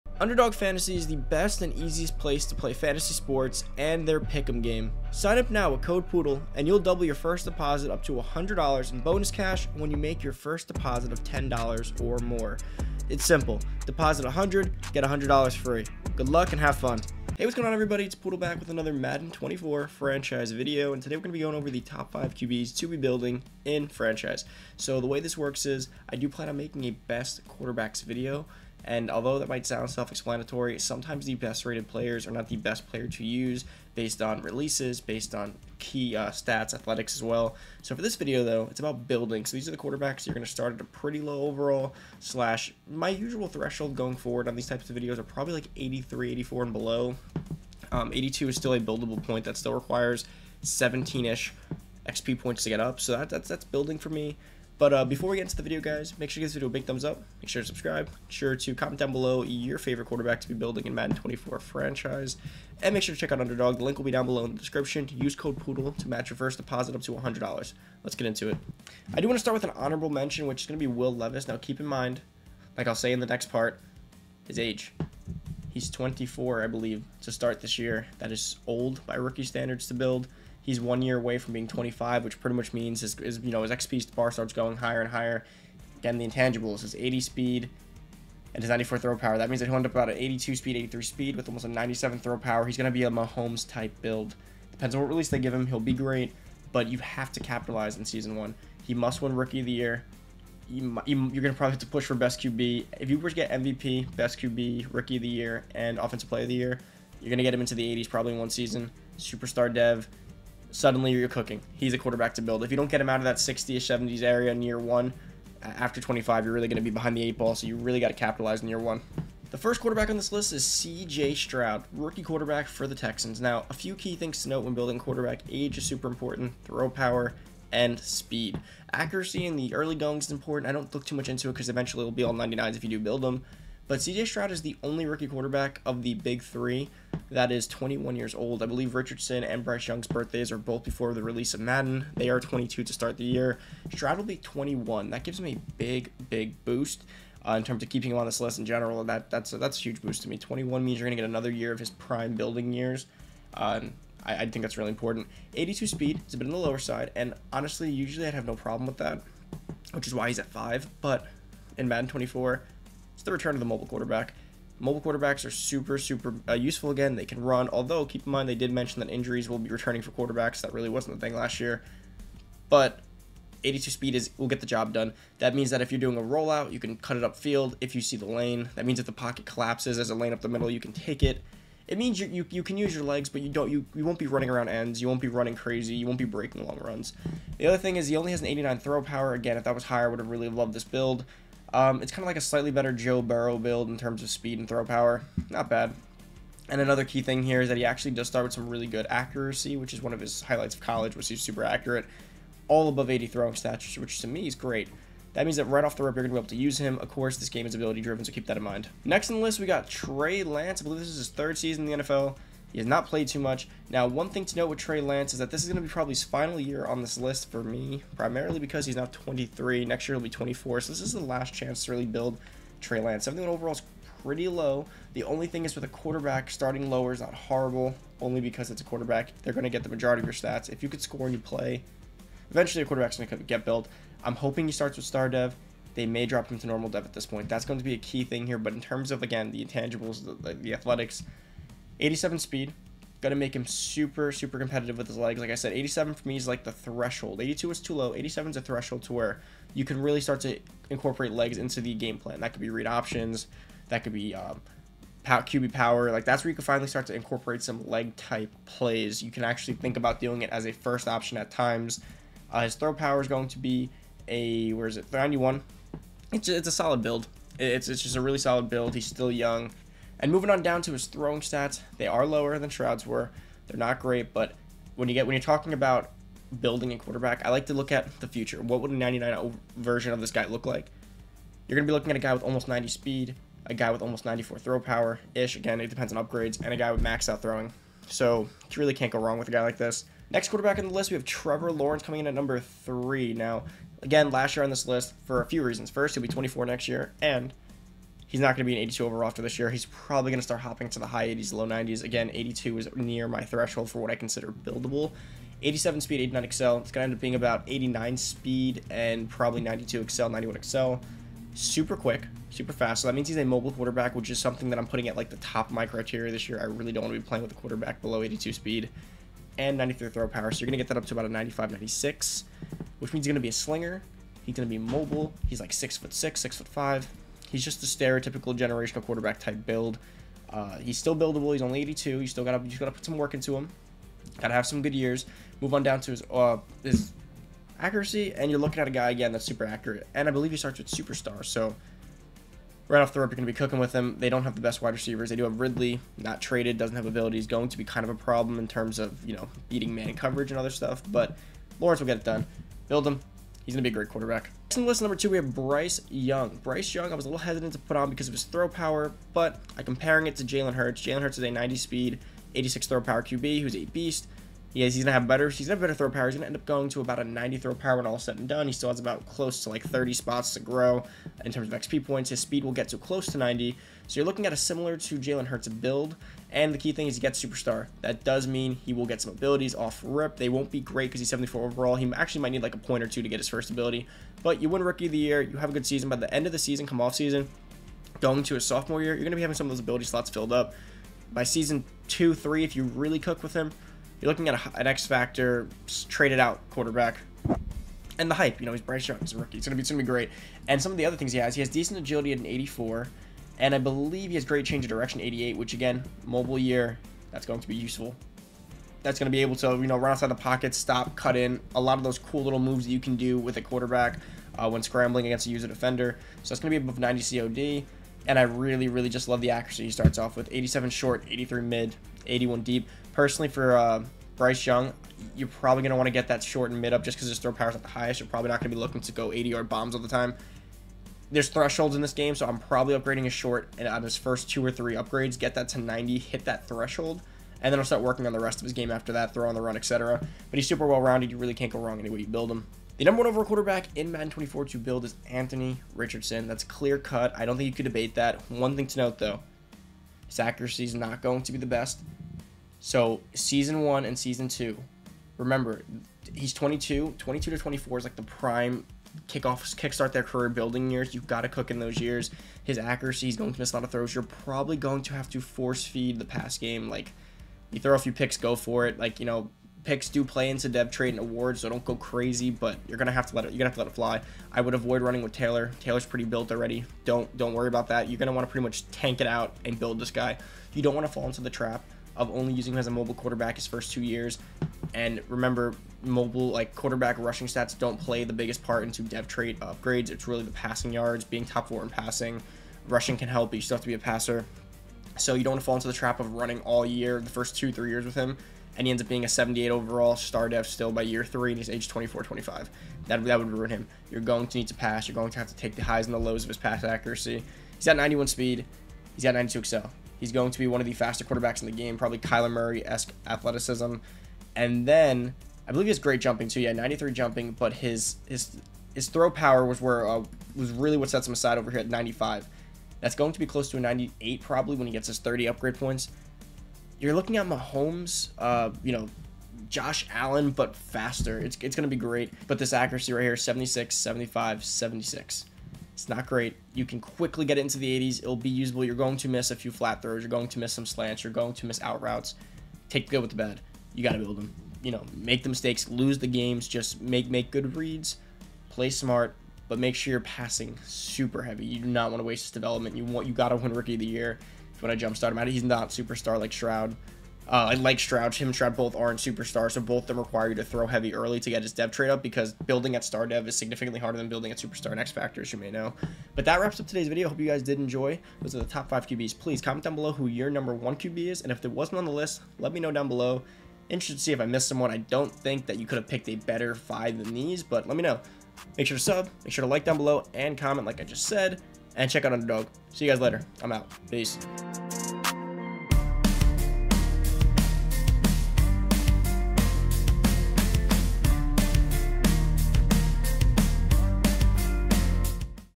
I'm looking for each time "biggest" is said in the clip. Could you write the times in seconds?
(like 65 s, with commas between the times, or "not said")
488 s.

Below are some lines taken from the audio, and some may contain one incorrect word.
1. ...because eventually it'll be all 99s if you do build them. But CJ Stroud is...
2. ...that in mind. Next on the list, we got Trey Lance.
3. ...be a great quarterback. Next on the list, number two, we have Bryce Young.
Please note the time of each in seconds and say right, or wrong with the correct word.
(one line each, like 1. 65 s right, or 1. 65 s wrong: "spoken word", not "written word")
1. 131 s right
2. 208 s right
3. 353 s right.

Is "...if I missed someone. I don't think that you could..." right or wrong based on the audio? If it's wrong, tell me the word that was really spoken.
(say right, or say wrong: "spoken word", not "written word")
right.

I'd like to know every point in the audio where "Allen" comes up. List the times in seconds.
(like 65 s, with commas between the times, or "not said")
530 s.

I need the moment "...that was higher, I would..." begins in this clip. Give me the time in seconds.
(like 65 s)
189 s.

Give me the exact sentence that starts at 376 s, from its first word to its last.
And the key thing is he gets superstar.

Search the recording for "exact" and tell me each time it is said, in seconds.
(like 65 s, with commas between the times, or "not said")
not said.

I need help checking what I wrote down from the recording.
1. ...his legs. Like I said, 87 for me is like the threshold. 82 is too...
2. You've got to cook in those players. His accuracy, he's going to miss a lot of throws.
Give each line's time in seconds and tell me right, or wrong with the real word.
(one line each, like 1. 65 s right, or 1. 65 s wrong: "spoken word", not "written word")
1. 245 s right
2. 461 s wrong: "years", not "players".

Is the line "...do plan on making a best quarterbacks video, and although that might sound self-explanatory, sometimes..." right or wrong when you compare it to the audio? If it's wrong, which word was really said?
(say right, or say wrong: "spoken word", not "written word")
right.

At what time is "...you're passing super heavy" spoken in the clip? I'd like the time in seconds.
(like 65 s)
550 s.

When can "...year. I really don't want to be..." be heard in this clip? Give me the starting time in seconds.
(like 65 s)
316 s.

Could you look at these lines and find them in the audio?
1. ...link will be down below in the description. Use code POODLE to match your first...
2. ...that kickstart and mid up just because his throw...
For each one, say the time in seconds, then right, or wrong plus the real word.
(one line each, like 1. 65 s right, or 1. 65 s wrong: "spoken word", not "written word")
1. 63 s right
2. 426 s wrong: "short", not "kickstart".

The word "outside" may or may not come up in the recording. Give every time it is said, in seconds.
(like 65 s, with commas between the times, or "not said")
410 s.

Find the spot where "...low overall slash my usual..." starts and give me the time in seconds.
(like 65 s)
41 s.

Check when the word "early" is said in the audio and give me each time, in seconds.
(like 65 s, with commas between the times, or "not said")
129 s, 561 s.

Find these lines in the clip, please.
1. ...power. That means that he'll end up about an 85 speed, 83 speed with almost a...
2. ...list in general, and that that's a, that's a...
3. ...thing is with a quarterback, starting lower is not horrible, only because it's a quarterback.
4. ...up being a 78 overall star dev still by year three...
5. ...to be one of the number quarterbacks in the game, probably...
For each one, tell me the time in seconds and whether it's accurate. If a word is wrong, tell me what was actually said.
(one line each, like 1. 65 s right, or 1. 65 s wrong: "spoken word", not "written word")
1. 89 s wrong: "82", not "85"
2. 148 s right
3. 225 s right
4. 499 s right
5. 510 s wrong: "faster", not "number".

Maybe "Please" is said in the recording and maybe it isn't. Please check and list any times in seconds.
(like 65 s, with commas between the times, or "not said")
569 s.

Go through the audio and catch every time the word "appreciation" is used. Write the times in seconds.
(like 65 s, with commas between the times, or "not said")
not said.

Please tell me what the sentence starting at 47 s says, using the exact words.
Um, 82 is still a buildable point that still requires 17-ish XP points to get up.